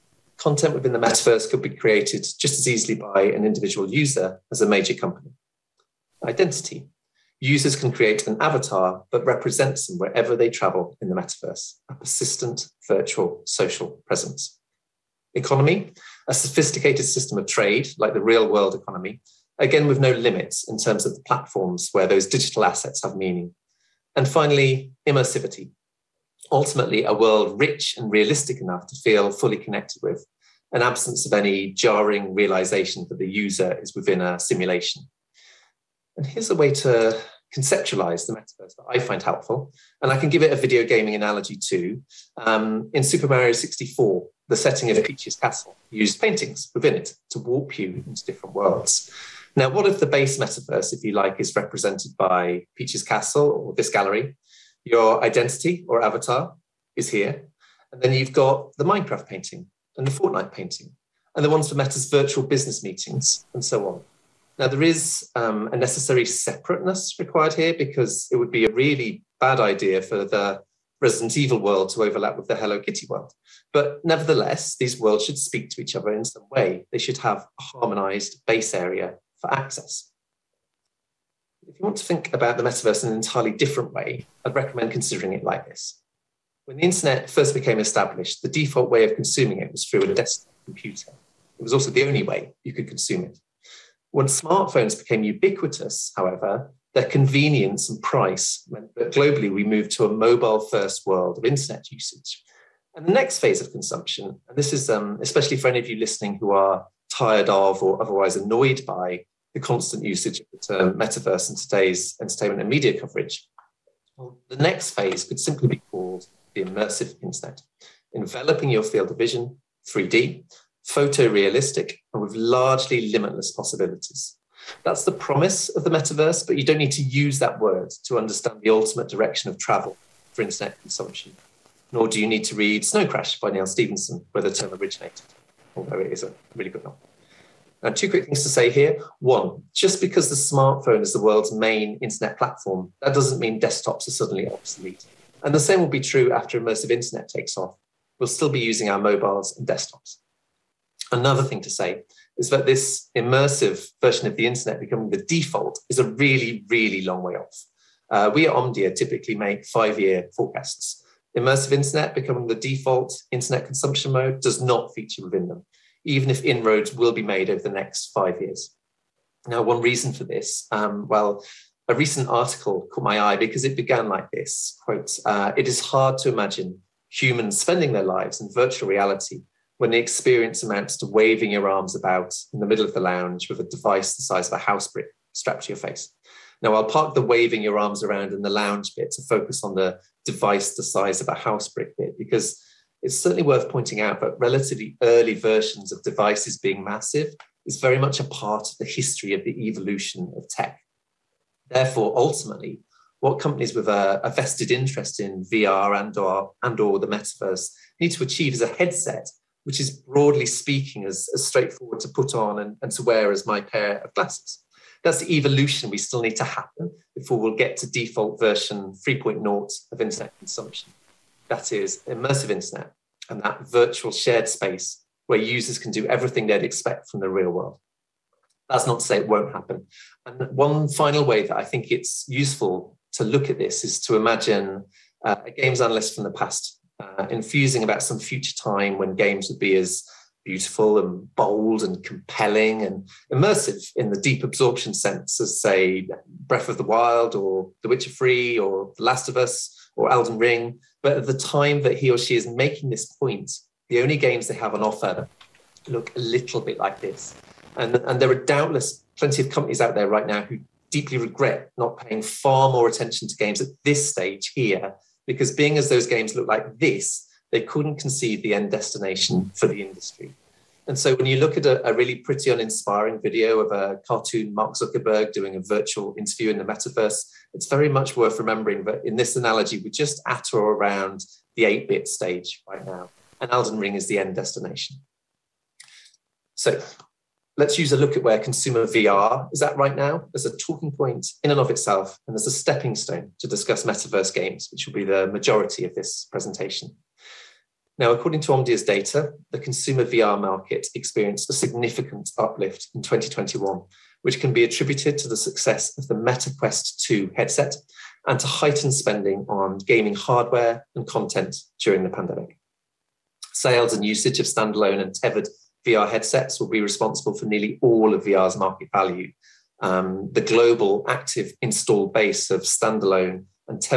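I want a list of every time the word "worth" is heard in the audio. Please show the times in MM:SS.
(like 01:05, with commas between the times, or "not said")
03:13, 04:38.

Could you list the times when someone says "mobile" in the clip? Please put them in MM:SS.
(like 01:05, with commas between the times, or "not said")
01:40, 02:28.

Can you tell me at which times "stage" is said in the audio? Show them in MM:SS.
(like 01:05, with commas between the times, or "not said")
04:24, 04:42.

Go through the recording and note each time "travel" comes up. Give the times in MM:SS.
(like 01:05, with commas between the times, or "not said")
00:10, 02:09.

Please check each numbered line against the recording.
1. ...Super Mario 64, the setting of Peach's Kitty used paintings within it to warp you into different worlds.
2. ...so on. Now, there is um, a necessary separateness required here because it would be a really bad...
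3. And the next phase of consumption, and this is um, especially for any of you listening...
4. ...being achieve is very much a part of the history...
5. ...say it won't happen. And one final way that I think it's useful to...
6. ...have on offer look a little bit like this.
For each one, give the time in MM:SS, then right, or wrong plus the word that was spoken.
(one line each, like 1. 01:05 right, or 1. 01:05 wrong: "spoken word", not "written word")
1. 00:43 wrong: "Castle", not "Kitty"
2. 01:03 right
3. 01:42 right
4. 03:16 wrong: "massive", not "achieve"
5. 03:49 right
6. 04:14 right.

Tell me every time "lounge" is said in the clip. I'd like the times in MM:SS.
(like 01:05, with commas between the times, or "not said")
03:02, 03:08.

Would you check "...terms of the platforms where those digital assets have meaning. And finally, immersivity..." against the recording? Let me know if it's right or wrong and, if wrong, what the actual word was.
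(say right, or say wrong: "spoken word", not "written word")
right.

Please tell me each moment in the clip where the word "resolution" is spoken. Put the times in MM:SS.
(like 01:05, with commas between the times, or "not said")
not said.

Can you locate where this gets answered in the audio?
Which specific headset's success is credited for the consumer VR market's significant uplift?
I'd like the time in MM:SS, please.
05:06.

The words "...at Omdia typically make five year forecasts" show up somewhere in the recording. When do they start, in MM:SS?
02:38.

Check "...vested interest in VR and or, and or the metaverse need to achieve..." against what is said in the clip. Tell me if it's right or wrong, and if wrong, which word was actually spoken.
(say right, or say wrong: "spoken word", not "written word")
right.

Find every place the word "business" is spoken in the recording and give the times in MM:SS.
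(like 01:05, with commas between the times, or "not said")
01:02.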